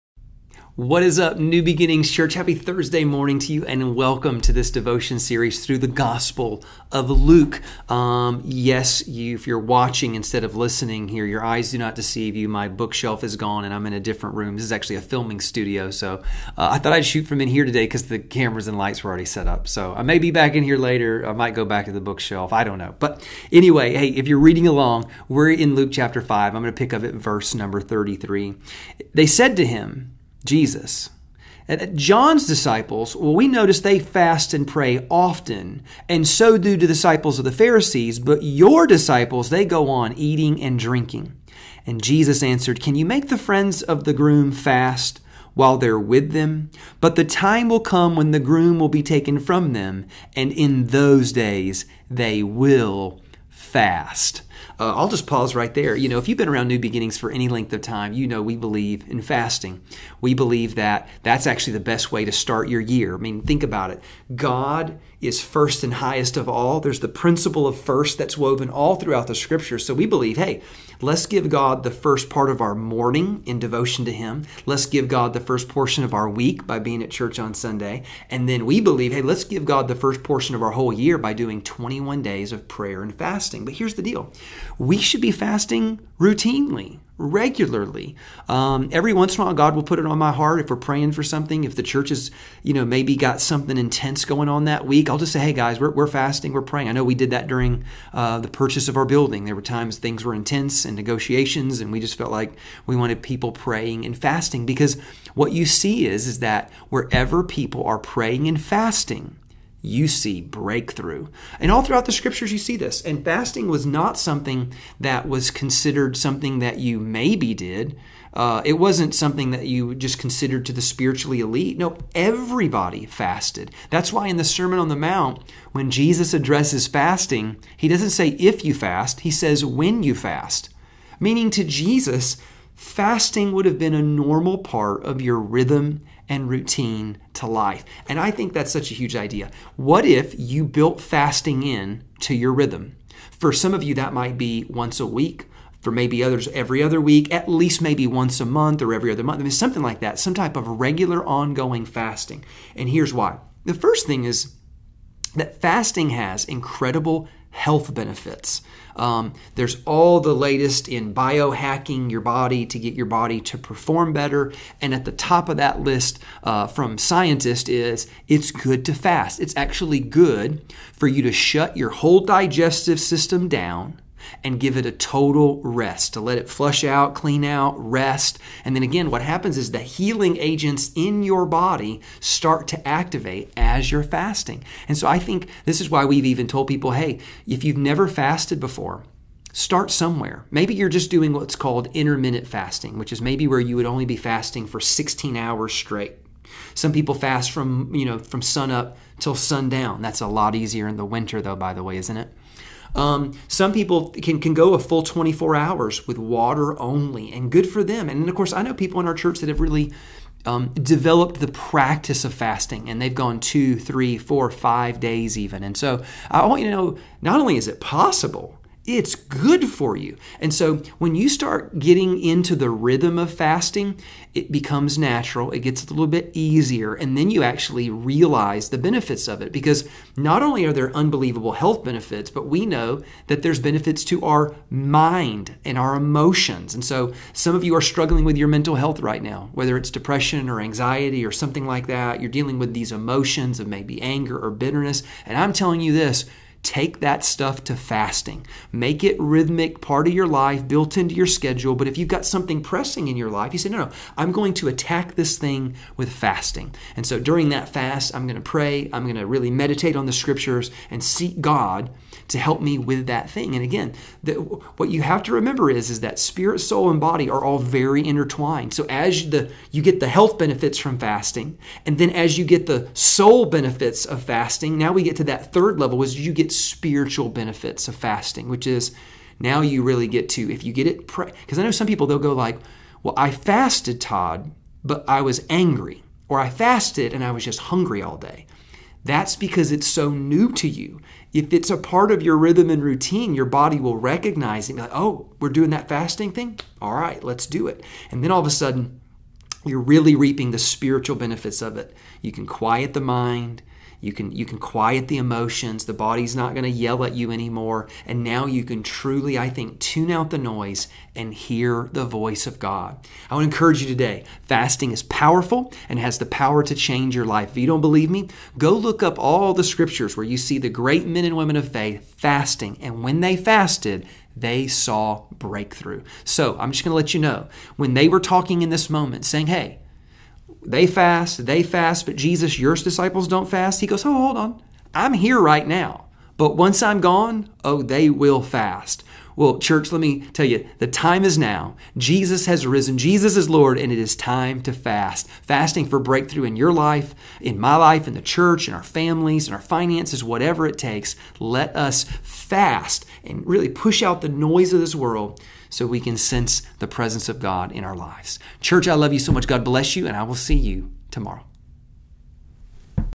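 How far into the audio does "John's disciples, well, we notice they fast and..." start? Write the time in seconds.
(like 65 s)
31 s.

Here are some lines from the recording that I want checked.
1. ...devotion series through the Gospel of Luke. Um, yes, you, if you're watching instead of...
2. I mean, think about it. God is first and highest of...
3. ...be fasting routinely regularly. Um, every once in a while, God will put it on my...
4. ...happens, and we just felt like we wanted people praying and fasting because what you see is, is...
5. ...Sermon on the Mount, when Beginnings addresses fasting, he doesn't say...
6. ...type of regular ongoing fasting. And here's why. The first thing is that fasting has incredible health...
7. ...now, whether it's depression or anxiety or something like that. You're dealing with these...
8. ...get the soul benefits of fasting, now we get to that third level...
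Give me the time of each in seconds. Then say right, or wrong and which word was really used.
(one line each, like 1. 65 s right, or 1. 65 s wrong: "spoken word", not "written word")
1. 4 s right
2. 63 s right
3. 85 s right
4. 100 s wrong: "negotiations", not "happens"
5. 124 s wrong: "Jesus", not "Beginnings"
6. 150 s right
7. 239 s right
8. 272 s right.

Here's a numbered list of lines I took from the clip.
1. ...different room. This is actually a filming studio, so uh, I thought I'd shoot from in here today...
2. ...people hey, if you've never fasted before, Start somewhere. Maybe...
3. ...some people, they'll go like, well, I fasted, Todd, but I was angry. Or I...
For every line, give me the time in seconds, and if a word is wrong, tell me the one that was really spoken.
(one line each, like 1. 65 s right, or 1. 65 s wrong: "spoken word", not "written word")
1. 13 s right
2. 186 s right
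3. 281 s right.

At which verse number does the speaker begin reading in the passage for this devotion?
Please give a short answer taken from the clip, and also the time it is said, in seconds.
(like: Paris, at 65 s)
33, at 27 s.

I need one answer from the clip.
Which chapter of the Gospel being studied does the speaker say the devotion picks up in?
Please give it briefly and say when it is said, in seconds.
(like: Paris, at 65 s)
Chapter 5, at 25 s.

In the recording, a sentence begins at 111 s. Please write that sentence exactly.
And all throughout the scriptures, you see this.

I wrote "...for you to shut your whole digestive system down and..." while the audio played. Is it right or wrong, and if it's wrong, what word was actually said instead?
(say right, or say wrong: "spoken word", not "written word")
right.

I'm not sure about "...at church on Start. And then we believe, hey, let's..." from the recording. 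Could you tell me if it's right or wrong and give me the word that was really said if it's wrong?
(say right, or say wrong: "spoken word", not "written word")
wrong: "Sunday", not "Start".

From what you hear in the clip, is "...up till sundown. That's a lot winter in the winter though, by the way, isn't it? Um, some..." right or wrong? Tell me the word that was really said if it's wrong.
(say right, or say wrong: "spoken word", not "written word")
wrong: "easier", not "winter".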